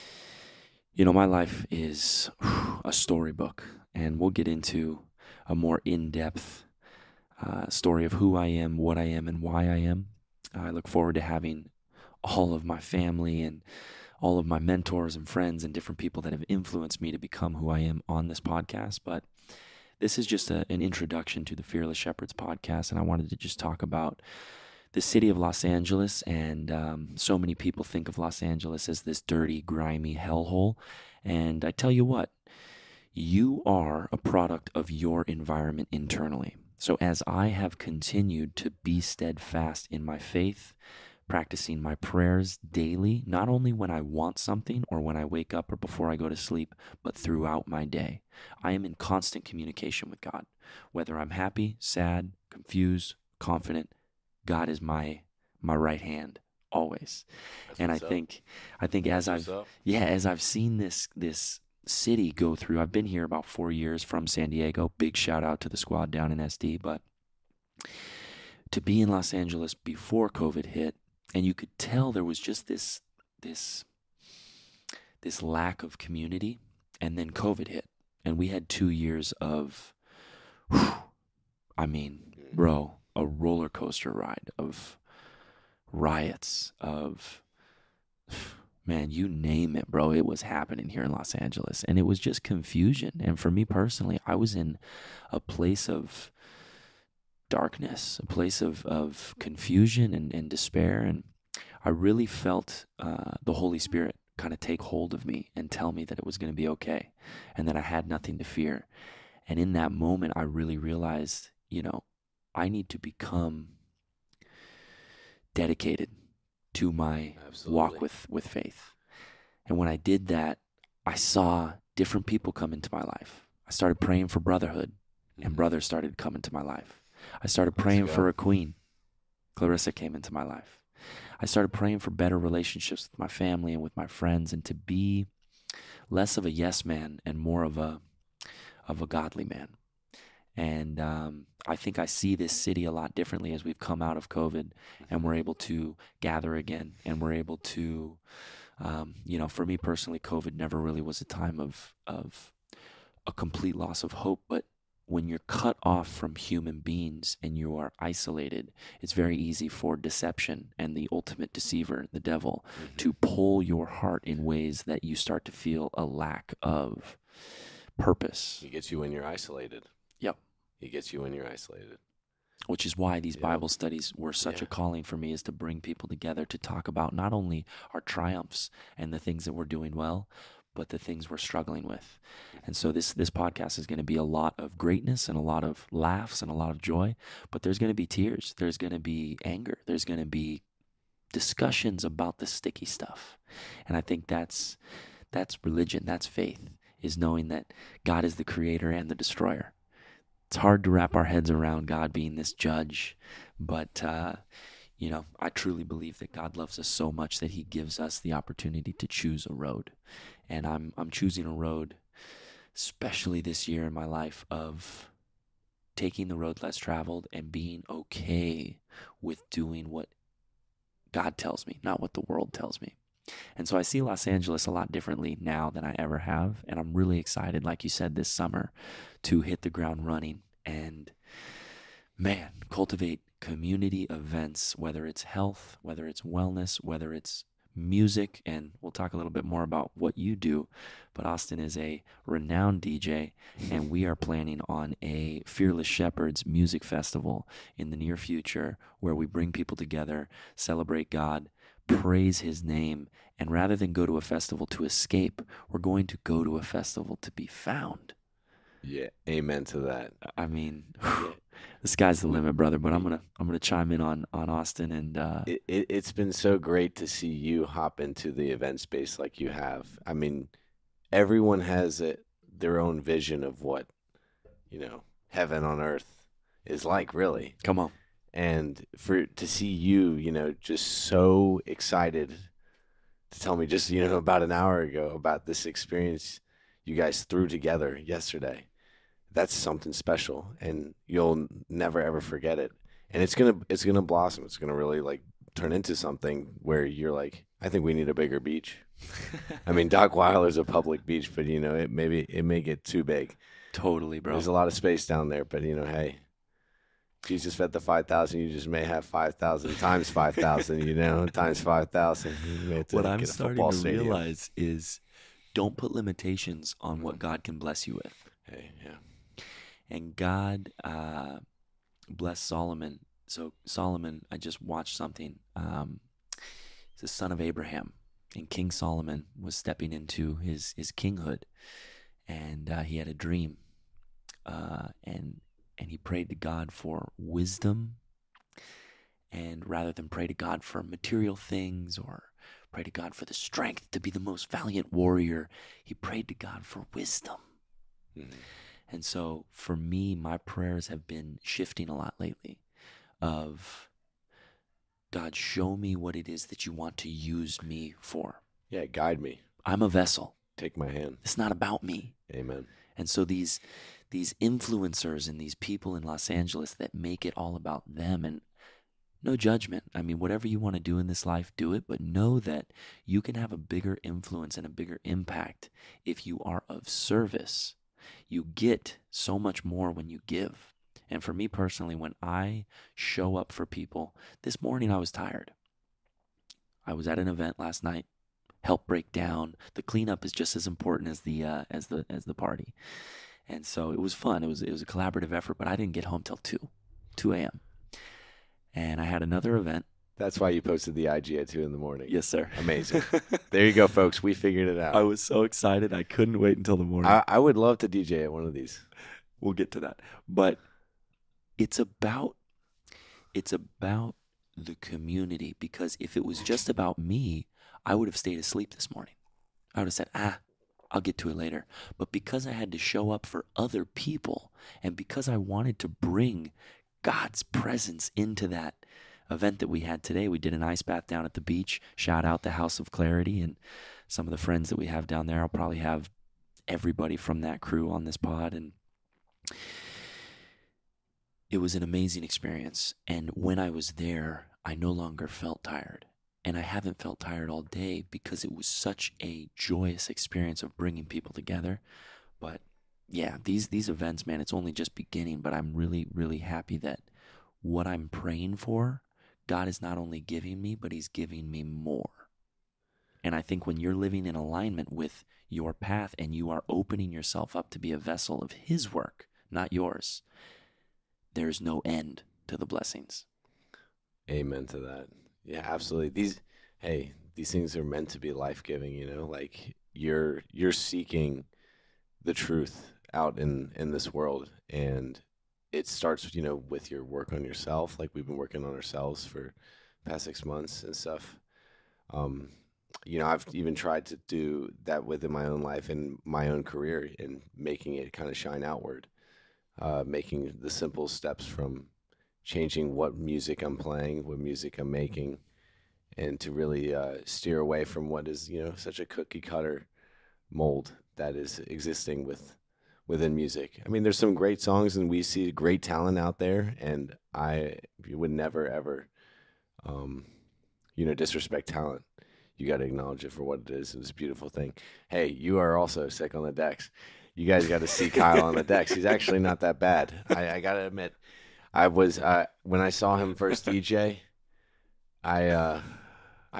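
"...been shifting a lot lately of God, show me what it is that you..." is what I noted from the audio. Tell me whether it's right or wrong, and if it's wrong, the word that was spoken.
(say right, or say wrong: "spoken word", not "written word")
right.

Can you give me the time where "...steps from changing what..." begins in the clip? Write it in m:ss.
8:21.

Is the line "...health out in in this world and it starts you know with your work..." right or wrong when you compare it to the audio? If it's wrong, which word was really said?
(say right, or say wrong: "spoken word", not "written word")
wrong: "truth", not "health".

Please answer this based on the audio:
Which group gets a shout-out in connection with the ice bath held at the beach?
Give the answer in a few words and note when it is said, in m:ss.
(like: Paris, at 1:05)
House of Clarity, at 7:12.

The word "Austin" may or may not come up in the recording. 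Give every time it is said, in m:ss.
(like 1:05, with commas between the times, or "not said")
4:01, 4:24.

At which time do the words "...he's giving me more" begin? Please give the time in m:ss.
7:40.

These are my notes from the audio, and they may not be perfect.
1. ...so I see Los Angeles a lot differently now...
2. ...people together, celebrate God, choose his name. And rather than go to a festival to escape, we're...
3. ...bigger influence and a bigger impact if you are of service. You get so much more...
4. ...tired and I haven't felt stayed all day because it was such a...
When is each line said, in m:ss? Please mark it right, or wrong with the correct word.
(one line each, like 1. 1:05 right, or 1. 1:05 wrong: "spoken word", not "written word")
1. 3:43 right
2. 4:09 wrong: "praise", not "choose"
3. 6:13 right
4. 7:25 wrong: "tired", not "stayed".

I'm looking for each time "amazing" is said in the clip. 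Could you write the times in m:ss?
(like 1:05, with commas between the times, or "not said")
6:42, 7:21.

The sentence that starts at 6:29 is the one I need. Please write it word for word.
The cleanup is just as important as the uh, as the as the party.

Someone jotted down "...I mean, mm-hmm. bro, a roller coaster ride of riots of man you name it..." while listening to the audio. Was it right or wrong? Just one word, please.
right.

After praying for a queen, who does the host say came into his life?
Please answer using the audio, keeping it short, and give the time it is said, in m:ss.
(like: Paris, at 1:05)
Clarissa, at 2:09.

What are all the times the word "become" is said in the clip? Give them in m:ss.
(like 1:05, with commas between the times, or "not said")
0:17, 1:52.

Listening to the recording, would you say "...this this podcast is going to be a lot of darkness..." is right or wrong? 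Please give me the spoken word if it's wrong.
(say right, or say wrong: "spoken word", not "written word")
wrong: "greatness", not "darkness".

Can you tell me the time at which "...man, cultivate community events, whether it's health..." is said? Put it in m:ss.
3:52.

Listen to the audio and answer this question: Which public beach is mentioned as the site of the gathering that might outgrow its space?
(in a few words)
Dockweiler.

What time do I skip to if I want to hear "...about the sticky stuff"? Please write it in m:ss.
3:12.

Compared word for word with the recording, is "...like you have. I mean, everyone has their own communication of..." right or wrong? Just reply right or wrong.
wrong.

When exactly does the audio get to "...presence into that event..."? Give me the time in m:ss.
7:07.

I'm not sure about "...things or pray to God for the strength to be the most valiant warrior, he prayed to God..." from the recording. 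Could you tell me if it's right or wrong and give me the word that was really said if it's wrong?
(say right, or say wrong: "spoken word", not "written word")
right.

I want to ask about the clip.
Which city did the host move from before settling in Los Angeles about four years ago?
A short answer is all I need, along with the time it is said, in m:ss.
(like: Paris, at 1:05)
San Diego, at 1:04.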